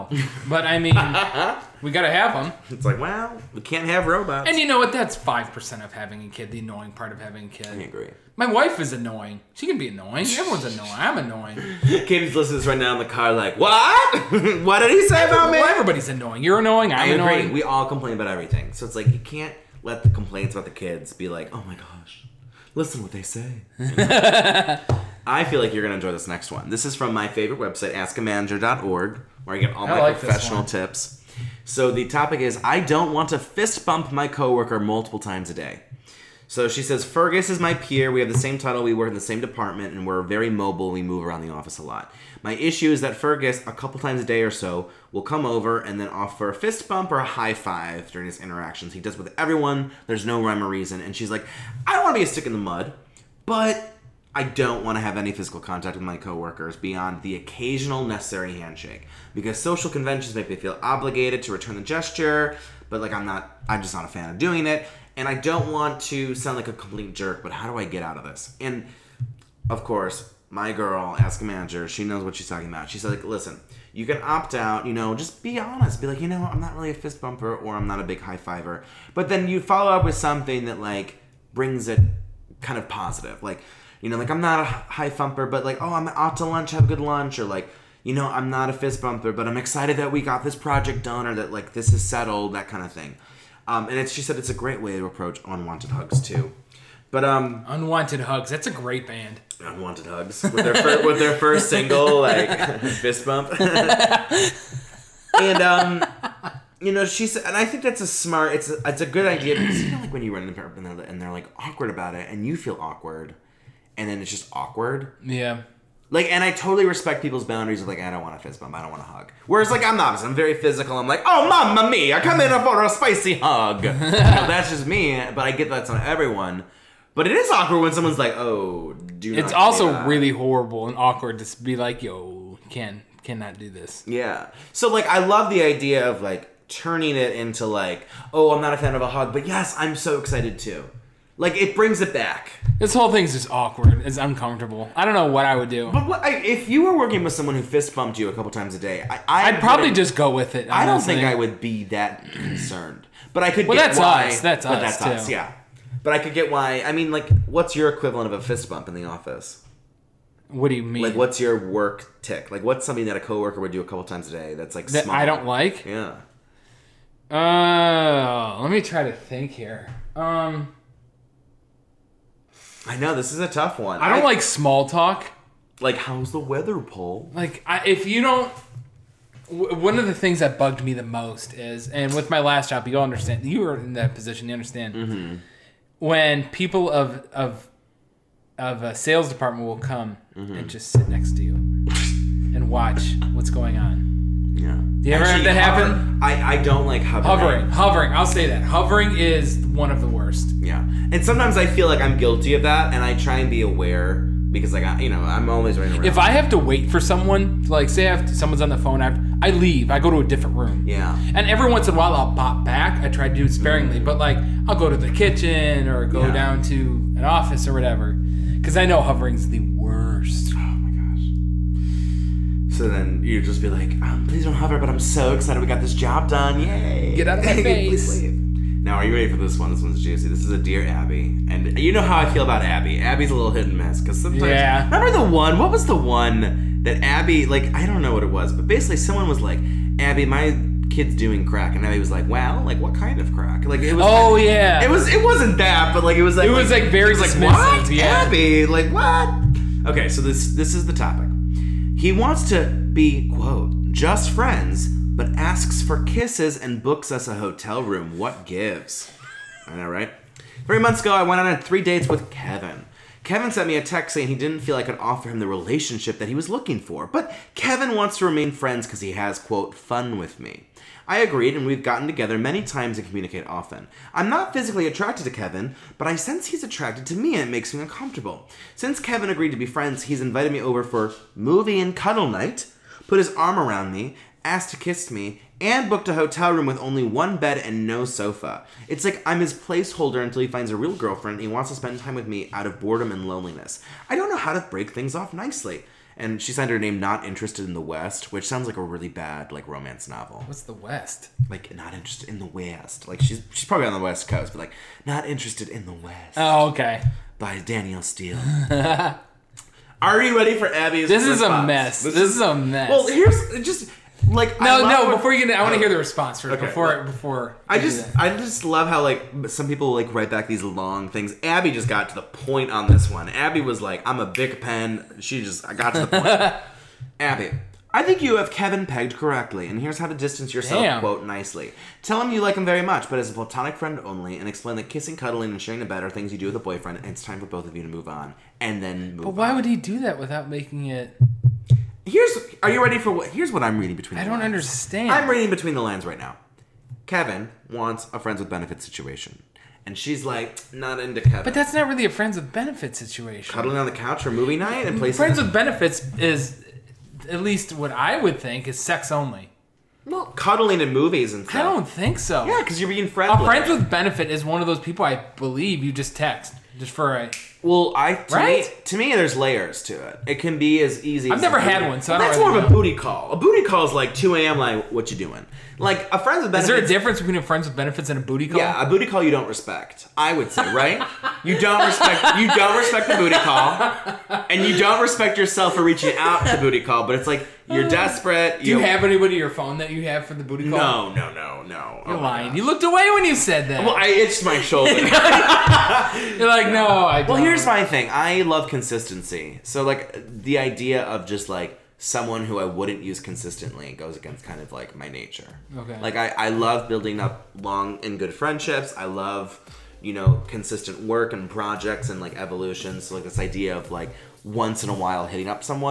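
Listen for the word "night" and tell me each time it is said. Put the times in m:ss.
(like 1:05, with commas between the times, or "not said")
4:42, 5:54.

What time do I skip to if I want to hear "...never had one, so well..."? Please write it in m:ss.
6:11.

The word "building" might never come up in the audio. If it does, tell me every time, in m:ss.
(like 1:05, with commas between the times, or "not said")
6:46.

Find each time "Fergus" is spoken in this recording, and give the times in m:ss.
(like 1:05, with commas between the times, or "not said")
0:37, 0:43.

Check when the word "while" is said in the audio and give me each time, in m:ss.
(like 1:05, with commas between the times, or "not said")
3:31, 6:54.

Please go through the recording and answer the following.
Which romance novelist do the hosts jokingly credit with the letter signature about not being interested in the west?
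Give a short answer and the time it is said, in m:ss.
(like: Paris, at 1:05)
Danielle Steel, at 5:07.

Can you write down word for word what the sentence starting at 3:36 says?
down to an office or whatever, because I know hovering's the worst.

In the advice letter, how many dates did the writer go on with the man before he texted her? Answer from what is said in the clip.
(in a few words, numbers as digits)
3.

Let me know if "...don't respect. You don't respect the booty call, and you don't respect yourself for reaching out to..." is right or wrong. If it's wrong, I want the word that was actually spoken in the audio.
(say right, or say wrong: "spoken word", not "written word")
right.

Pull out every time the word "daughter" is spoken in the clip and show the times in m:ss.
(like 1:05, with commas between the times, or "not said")
not said.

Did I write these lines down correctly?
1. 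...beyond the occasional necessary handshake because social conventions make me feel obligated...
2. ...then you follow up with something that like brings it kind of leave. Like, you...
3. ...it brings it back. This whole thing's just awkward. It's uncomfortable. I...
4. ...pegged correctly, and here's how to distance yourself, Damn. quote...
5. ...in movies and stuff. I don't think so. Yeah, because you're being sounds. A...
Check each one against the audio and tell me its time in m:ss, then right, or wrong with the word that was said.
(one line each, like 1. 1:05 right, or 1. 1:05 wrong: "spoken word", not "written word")
1. 0:56 right
2. 1:19 wrong: "positive", not "leave"
3. 2:21 right
4. 5:28 right
5. 6:00 wrong: "friends", not "sounds".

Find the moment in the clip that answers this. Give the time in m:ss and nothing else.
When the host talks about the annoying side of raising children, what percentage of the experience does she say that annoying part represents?
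0:05.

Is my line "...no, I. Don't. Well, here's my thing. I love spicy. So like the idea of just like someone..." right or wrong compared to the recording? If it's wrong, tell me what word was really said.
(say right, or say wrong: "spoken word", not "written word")
wrong: "consistency", not "spicy".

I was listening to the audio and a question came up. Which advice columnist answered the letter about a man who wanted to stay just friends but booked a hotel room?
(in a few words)
Dear Abby.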